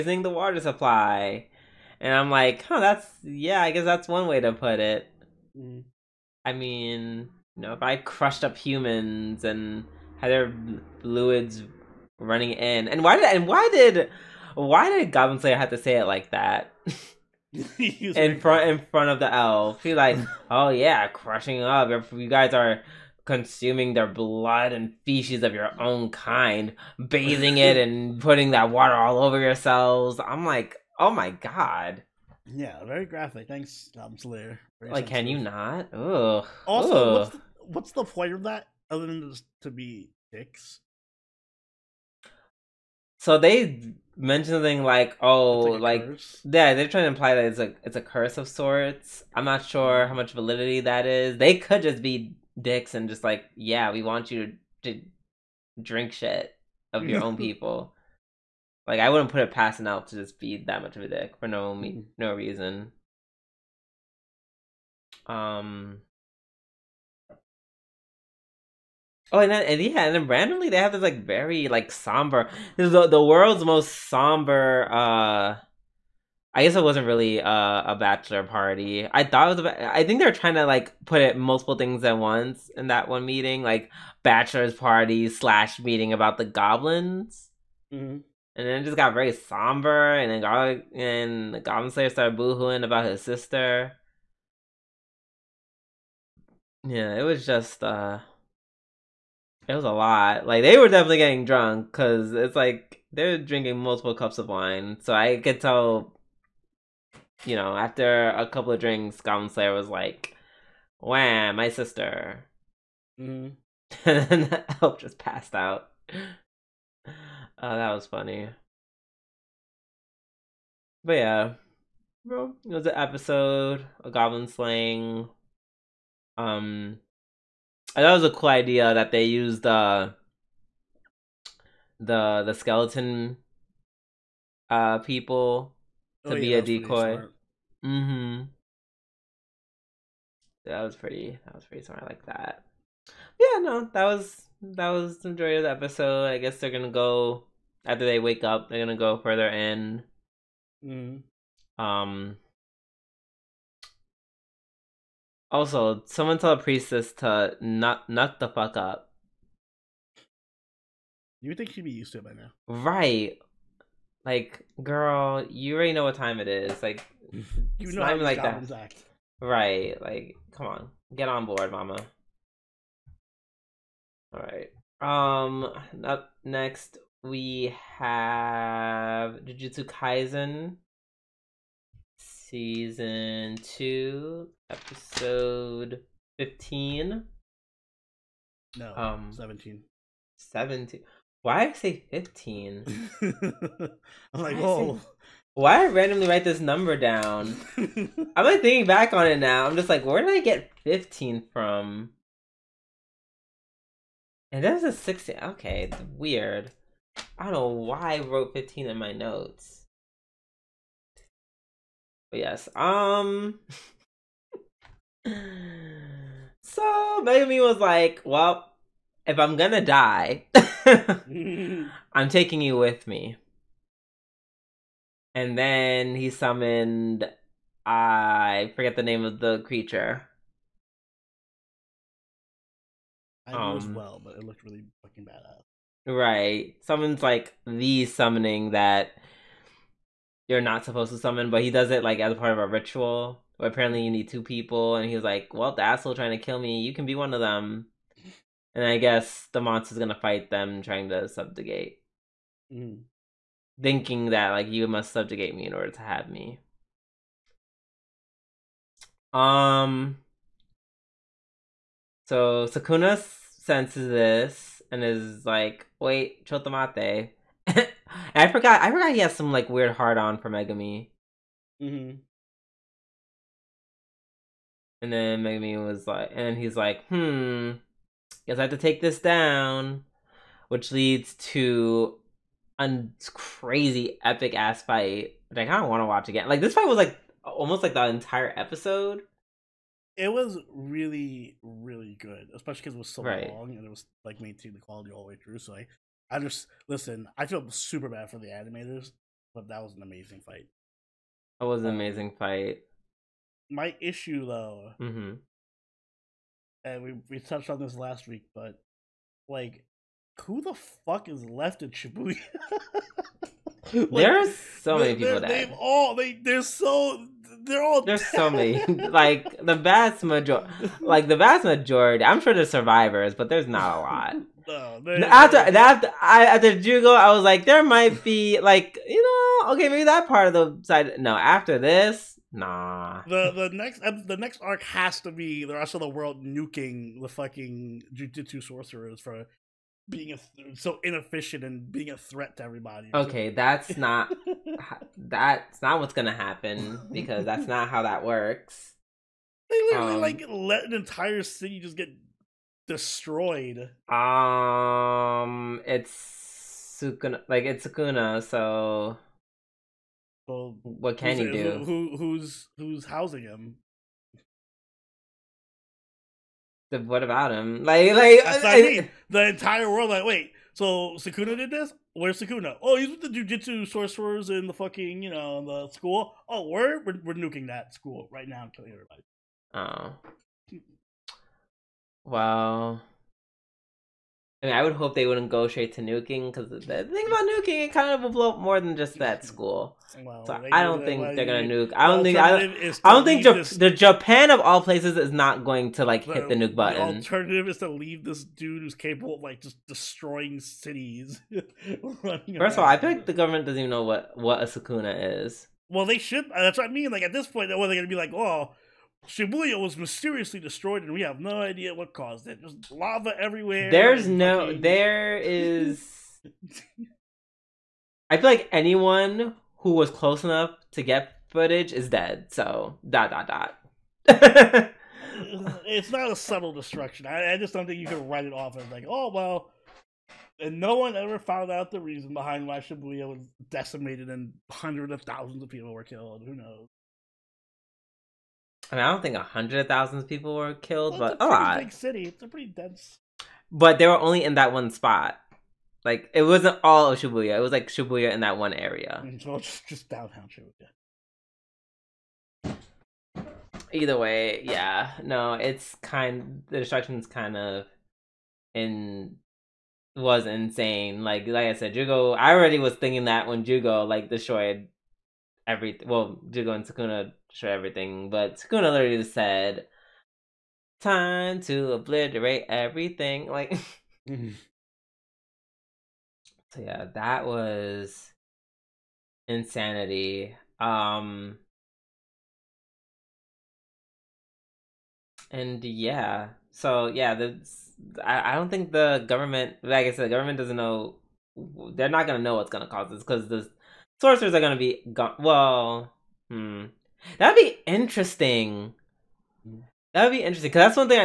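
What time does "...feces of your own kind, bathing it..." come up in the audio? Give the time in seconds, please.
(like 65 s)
25 s.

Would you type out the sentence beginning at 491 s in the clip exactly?
They're not gonna know what's gonna cause this because the sorcerers are gonna be gone.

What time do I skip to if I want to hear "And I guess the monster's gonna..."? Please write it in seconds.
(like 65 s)
248 s.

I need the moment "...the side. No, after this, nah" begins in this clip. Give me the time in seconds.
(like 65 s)
330 s.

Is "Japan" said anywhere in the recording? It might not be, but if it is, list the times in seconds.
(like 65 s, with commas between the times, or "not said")
393 s.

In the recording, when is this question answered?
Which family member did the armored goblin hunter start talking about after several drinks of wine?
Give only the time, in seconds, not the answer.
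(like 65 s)
111 s.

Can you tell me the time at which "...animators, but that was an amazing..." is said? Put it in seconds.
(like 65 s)
298 s.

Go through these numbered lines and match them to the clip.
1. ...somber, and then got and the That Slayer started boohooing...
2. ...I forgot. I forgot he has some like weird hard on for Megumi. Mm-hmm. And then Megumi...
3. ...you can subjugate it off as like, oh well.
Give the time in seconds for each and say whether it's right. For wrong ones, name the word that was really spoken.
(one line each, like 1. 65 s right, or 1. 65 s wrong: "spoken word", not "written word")
1. 89 s wrong: "Goblin", not "That"
2. 267 s right
3. 427 s wrong: "write", not "subjugate".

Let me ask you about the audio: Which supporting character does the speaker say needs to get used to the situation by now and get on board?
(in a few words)
Priestess.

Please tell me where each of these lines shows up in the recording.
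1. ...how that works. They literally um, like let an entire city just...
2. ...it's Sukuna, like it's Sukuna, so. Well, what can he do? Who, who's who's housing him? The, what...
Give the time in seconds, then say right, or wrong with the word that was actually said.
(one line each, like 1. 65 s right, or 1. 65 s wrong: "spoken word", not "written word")
1. 347 s right
2. 355 s right.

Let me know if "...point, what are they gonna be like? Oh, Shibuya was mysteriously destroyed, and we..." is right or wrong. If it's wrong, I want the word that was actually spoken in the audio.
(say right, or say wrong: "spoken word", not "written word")
right.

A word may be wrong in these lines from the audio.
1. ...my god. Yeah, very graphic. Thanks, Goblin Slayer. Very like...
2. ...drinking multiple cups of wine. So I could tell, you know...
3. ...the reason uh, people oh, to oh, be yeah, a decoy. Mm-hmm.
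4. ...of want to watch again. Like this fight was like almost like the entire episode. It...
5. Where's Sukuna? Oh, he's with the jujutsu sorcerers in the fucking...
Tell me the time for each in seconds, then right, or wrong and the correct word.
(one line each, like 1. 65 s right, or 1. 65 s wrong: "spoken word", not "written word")
1. 31 s right
2. 103 s right
3. 132 s wrong: "skeleton", not "reason"
4. 285 s right
5. 372 s right.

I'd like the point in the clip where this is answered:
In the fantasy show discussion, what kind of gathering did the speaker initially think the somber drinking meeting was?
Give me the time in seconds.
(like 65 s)
77 s.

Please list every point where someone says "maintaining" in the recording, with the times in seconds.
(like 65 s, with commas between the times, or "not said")
294 s.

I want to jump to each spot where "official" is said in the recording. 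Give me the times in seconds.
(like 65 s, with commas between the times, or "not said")
not said.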